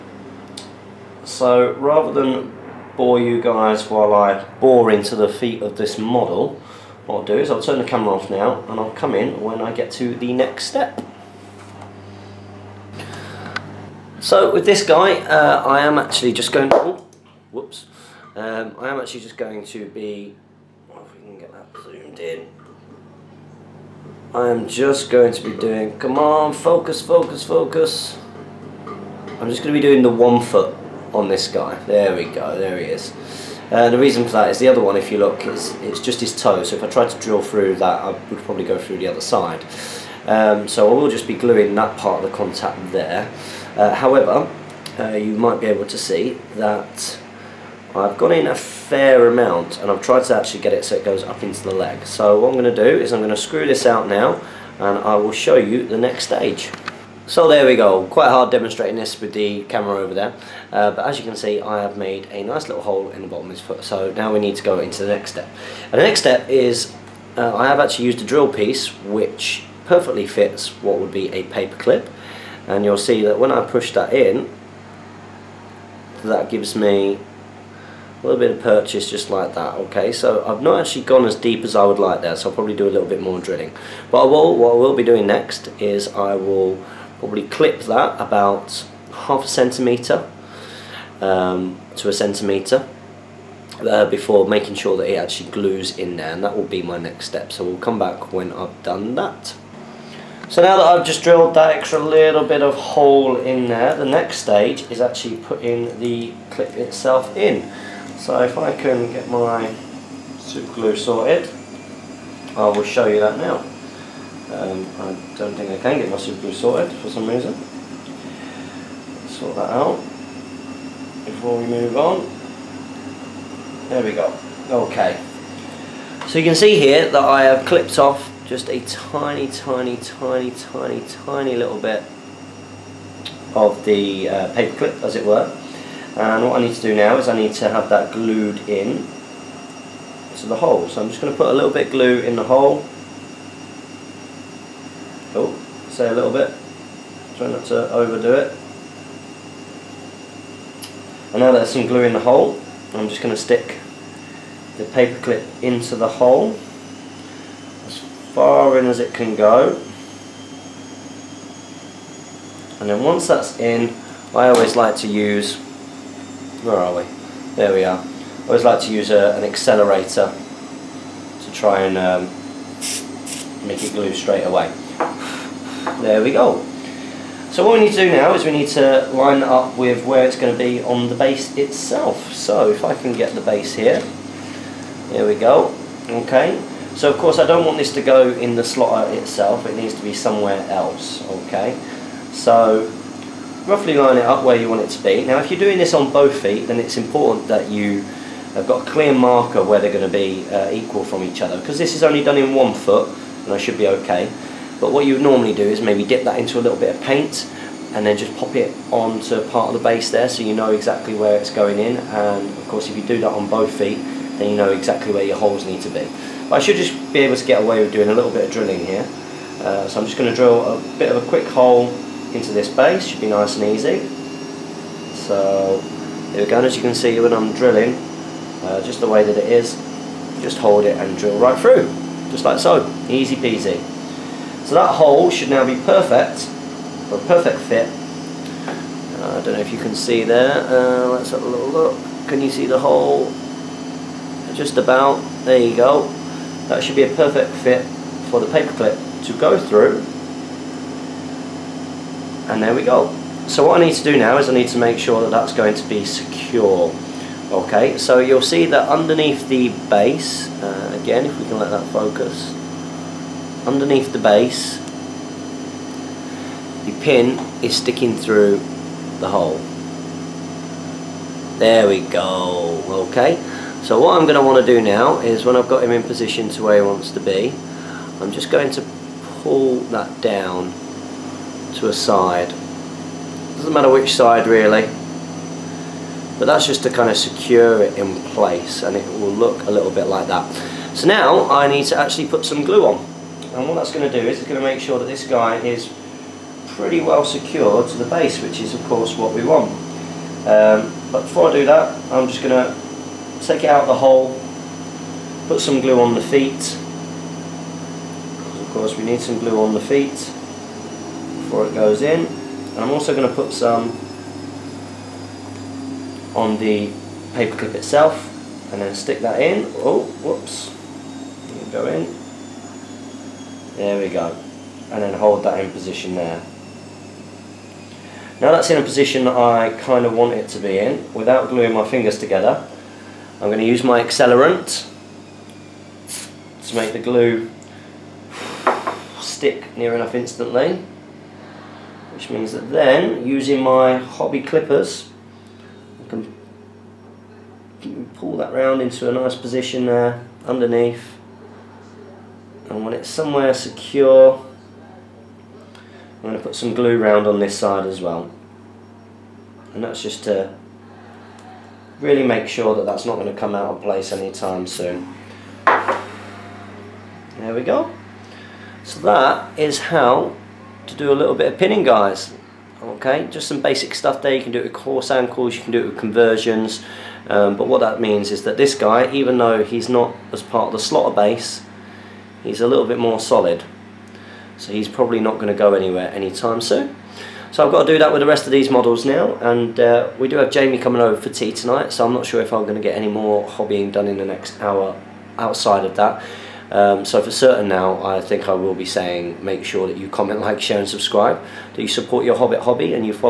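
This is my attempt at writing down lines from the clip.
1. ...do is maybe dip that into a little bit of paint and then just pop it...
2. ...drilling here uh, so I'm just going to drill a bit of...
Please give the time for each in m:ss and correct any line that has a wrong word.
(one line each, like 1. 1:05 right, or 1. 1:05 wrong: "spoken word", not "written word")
1. 3:25 right
2. 3:38 right.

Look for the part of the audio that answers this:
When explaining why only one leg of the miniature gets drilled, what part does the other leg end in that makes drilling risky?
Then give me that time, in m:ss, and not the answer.
0:36.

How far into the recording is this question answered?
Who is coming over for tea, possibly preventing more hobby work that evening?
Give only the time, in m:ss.
6:30.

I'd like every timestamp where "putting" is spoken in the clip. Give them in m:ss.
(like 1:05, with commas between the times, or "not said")
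1:45.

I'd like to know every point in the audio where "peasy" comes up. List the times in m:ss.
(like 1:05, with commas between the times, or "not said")
3:53.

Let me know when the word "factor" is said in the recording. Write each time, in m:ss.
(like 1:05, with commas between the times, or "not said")
not said.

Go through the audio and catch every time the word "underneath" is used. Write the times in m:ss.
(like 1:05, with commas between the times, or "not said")
4:18, 4:23, 5:50.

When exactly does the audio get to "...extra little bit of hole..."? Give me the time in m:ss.
1:41.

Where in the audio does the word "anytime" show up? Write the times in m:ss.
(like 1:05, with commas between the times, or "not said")
6:04, 6:26.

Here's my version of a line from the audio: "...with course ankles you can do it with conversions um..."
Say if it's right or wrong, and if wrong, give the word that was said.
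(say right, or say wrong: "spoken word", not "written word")
right.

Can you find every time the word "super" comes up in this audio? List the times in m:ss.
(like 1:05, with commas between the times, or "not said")
1:50, 1:56.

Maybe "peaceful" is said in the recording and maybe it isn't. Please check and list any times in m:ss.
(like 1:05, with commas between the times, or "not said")
not said.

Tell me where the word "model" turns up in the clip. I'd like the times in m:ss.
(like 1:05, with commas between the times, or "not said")
0:05, 6:28.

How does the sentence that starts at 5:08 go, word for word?
Of course we need some glue on the feet before it goes in.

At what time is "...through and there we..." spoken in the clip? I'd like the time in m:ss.
4:09.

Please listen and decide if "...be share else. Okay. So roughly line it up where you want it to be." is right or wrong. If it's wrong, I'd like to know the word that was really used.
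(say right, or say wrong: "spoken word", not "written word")
wrong: "somewhere", not "share".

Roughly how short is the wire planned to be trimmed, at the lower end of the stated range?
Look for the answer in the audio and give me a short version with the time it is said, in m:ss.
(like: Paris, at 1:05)
half a centimeter, at 1:29.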